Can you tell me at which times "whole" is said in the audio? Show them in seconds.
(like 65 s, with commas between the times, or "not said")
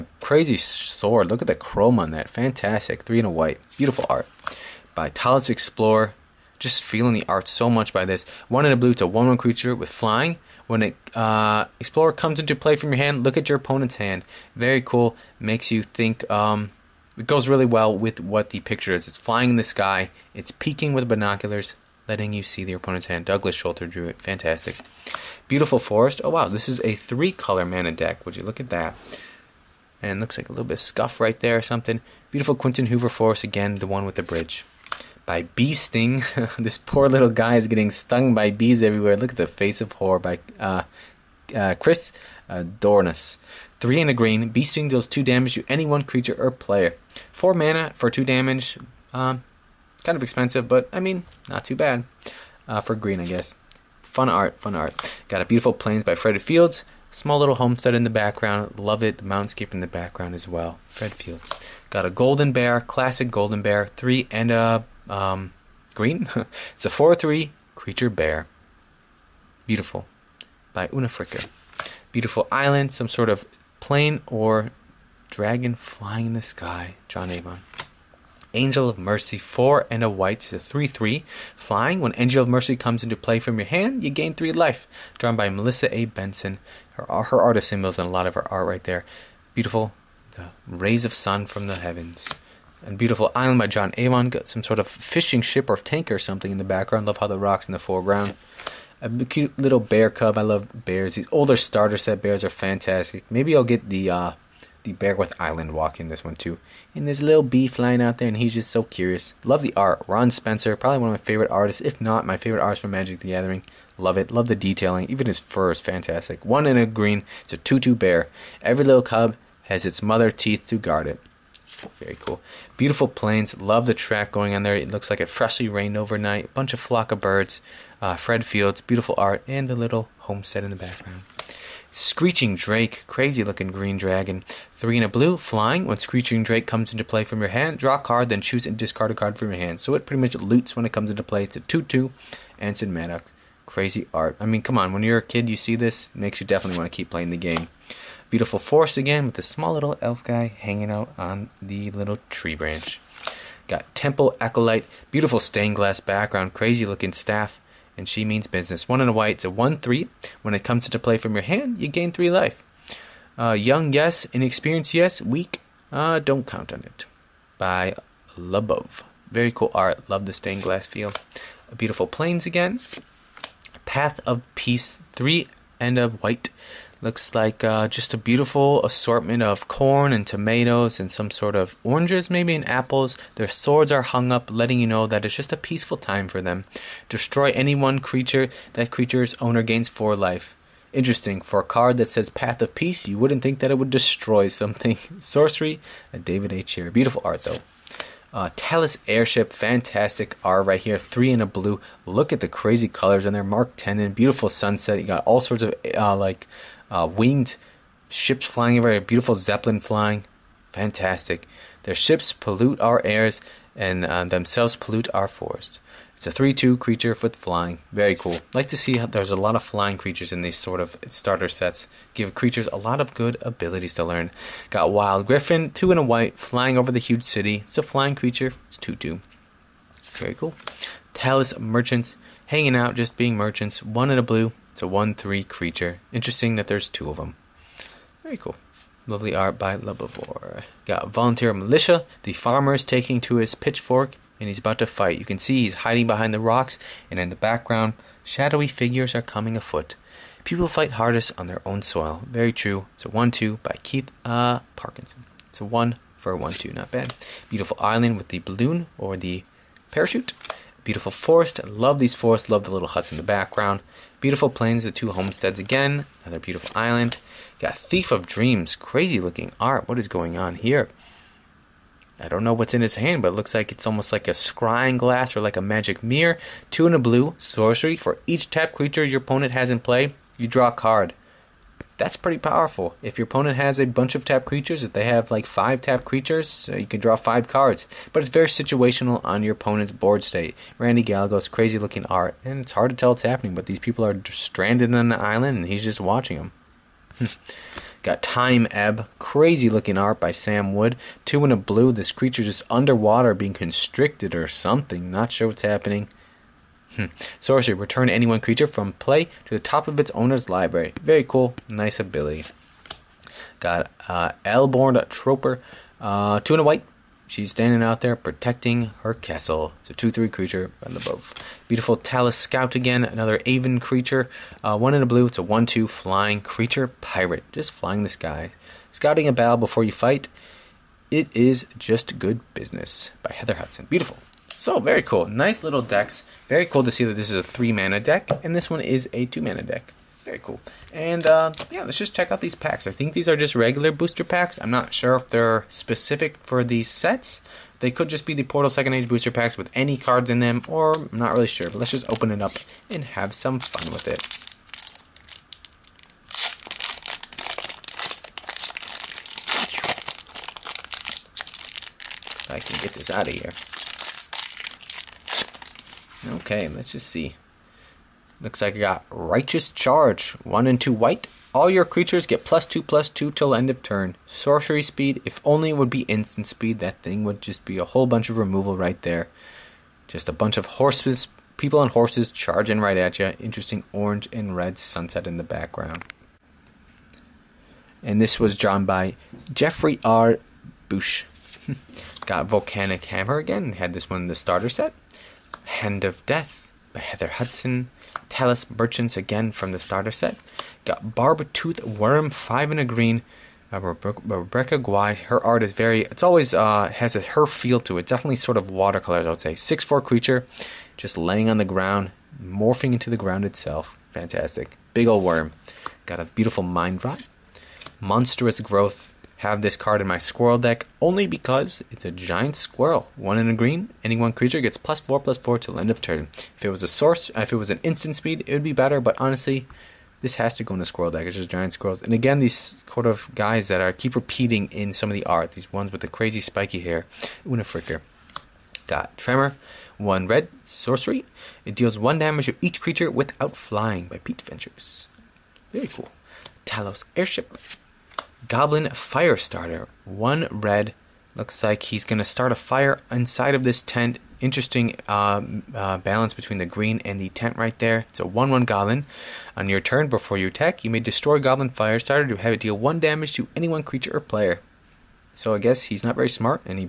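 377 s.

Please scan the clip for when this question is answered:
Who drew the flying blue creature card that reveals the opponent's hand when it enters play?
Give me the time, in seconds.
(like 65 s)
23 s.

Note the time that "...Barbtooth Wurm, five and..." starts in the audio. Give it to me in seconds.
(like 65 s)
401 s.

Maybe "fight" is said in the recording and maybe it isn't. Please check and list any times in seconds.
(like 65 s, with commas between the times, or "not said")
244 s, 250 s, 329 s.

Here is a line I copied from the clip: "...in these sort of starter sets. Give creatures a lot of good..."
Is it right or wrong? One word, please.
right.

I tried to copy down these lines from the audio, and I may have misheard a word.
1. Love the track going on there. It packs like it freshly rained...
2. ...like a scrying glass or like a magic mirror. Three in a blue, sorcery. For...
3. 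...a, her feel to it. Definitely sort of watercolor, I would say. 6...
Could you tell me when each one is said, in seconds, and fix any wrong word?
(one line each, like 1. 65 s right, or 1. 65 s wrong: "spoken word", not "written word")
1. 123 s wrong: "looks", not "packs"
2. 274 s wrong: "Two", not "Three"
3. 407 s right.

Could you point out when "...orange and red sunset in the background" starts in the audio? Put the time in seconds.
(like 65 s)
383 s.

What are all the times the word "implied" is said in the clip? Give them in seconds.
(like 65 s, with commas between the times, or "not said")
not said.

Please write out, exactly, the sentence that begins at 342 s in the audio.
I think these are just regular booster packs.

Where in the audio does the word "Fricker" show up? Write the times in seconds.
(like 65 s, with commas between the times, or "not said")
71 s, 437 s.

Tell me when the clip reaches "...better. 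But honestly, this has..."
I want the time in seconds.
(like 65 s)
428 s.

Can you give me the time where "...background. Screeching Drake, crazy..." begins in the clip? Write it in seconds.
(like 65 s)
130 s.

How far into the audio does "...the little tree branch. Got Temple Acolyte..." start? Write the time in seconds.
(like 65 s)
151 s.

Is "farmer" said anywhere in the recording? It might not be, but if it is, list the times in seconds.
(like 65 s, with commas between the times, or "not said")
242 s.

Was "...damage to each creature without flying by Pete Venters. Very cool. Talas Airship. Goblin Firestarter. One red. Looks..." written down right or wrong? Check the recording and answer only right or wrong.
right.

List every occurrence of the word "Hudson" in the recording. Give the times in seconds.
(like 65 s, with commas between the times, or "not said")
333 s, 397 s.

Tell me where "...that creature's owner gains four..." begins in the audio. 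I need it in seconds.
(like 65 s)
188 s.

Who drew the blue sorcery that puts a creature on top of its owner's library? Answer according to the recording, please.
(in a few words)
Sam Wood.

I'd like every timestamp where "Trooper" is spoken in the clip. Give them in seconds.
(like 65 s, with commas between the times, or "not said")
315 s.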